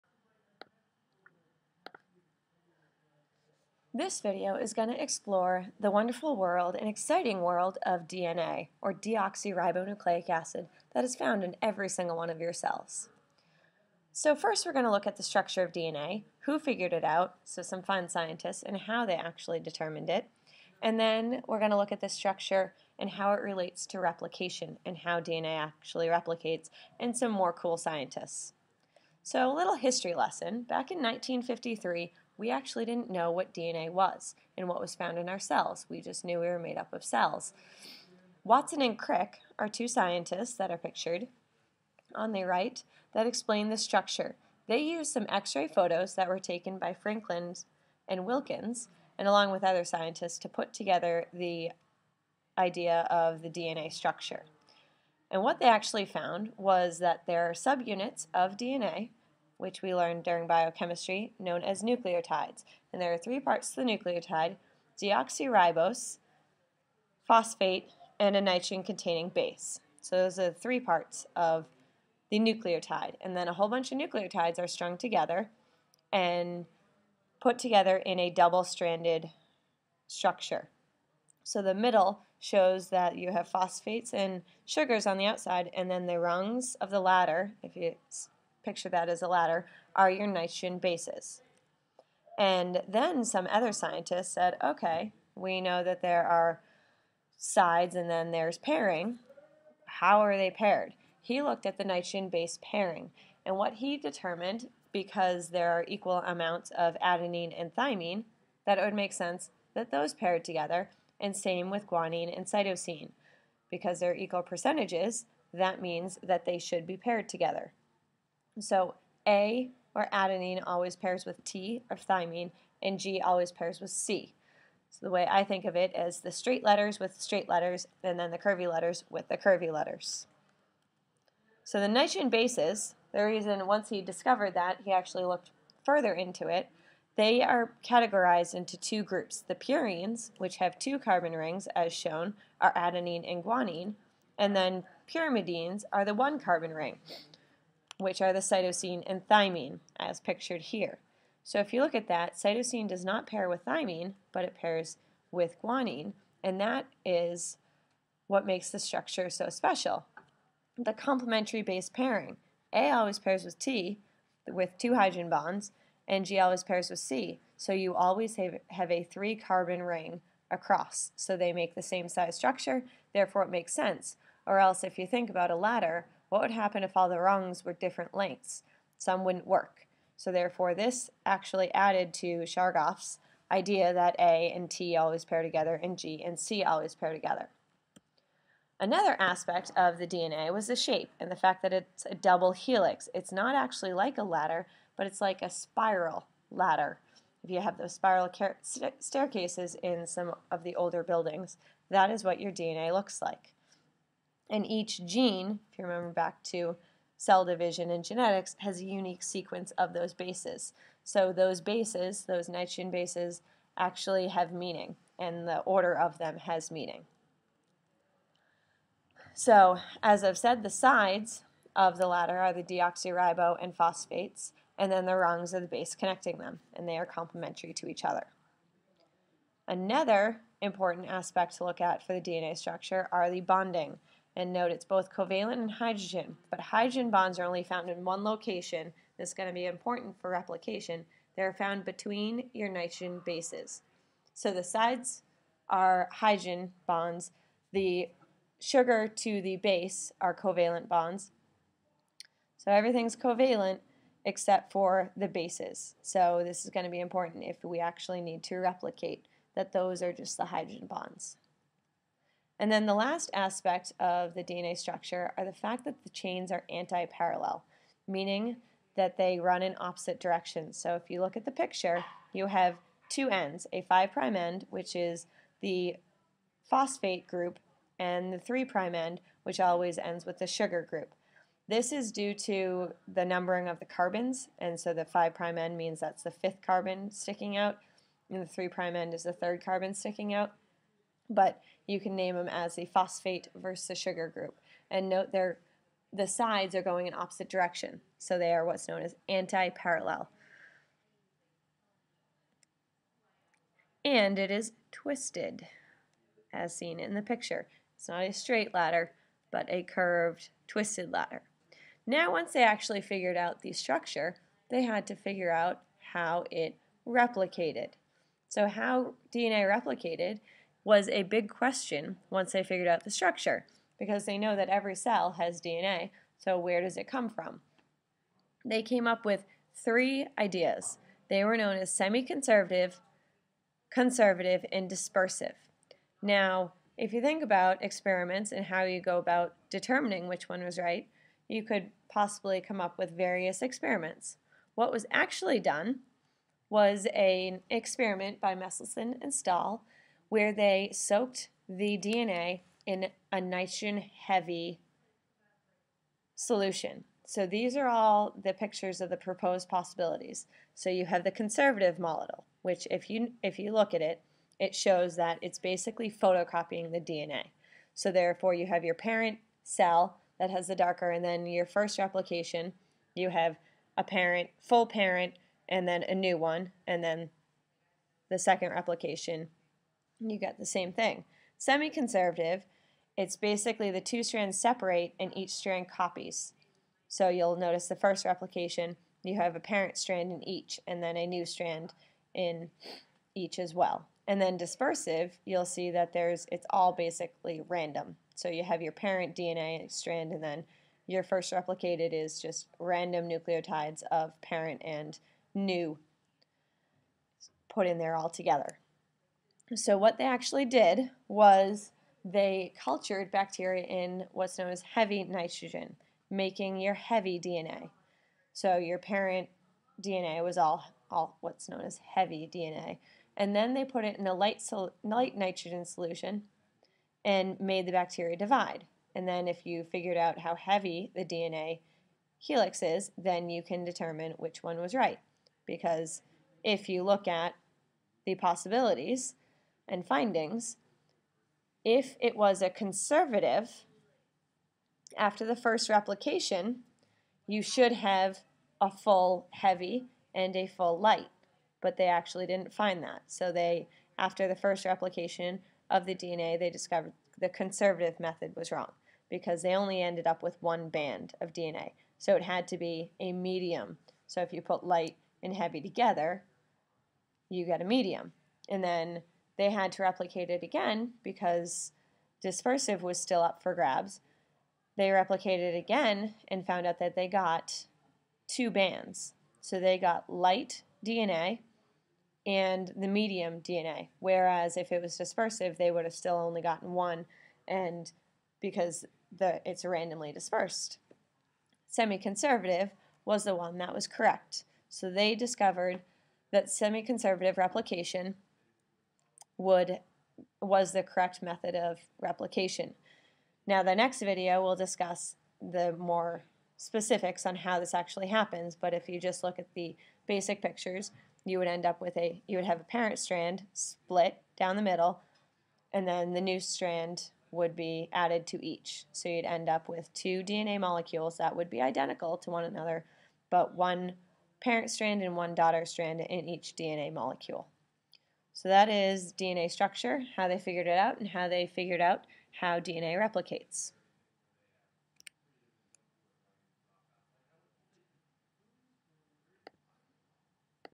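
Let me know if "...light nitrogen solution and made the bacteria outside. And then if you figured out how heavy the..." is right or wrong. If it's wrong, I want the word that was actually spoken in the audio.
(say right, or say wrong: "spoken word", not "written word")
wrong: "divide", not "outside".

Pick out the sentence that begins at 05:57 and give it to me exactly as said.
So these are all the pictures of the proposed possibilities.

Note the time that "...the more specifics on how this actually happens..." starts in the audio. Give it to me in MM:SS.
08:25.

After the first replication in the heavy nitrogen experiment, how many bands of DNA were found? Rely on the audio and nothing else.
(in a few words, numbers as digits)
1.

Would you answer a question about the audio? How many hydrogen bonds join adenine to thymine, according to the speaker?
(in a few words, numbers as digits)
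2.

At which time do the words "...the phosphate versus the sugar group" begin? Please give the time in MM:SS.
04:52.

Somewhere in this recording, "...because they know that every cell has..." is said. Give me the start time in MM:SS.
05:23.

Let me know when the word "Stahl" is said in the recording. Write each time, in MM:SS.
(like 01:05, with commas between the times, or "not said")
05:49.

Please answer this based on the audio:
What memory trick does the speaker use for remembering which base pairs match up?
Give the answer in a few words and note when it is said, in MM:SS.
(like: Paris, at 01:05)
Straight letters with straight letters, at 02:06.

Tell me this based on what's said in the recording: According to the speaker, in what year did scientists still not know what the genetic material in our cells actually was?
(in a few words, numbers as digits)
1953.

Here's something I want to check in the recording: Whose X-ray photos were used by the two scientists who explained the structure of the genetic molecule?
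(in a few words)
Franklin and Wilkins.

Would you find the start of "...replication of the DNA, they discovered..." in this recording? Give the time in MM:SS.
07:34.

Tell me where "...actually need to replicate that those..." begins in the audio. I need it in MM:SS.
04:17.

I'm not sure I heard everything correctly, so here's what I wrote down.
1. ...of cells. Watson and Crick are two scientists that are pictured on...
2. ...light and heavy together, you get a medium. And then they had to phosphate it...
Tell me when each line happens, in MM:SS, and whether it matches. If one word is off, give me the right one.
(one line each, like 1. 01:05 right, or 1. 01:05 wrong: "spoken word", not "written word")
1. 00:36 right
2. 07:44 wrong: "replicate", not "phosphate".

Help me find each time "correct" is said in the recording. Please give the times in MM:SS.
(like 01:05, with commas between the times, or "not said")
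08:14, 08:21.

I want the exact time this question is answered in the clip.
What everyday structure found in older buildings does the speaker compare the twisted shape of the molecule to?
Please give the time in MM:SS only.
03:17.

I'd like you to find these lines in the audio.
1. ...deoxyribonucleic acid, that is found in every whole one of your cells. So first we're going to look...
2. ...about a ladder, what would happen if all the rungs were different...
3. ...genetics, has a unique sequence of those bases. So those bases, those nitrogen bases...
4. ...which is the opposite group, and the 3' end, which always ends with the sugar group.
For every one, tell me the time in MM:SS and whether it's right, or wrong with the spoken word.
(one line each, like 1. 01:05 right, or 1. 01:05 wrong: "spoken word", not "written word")
1. 00:08 wrong: "single", not "whole"
2. 02:55 right
3. 03:28 right
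4. 04:34 wrong: "phosphate", not "opposite".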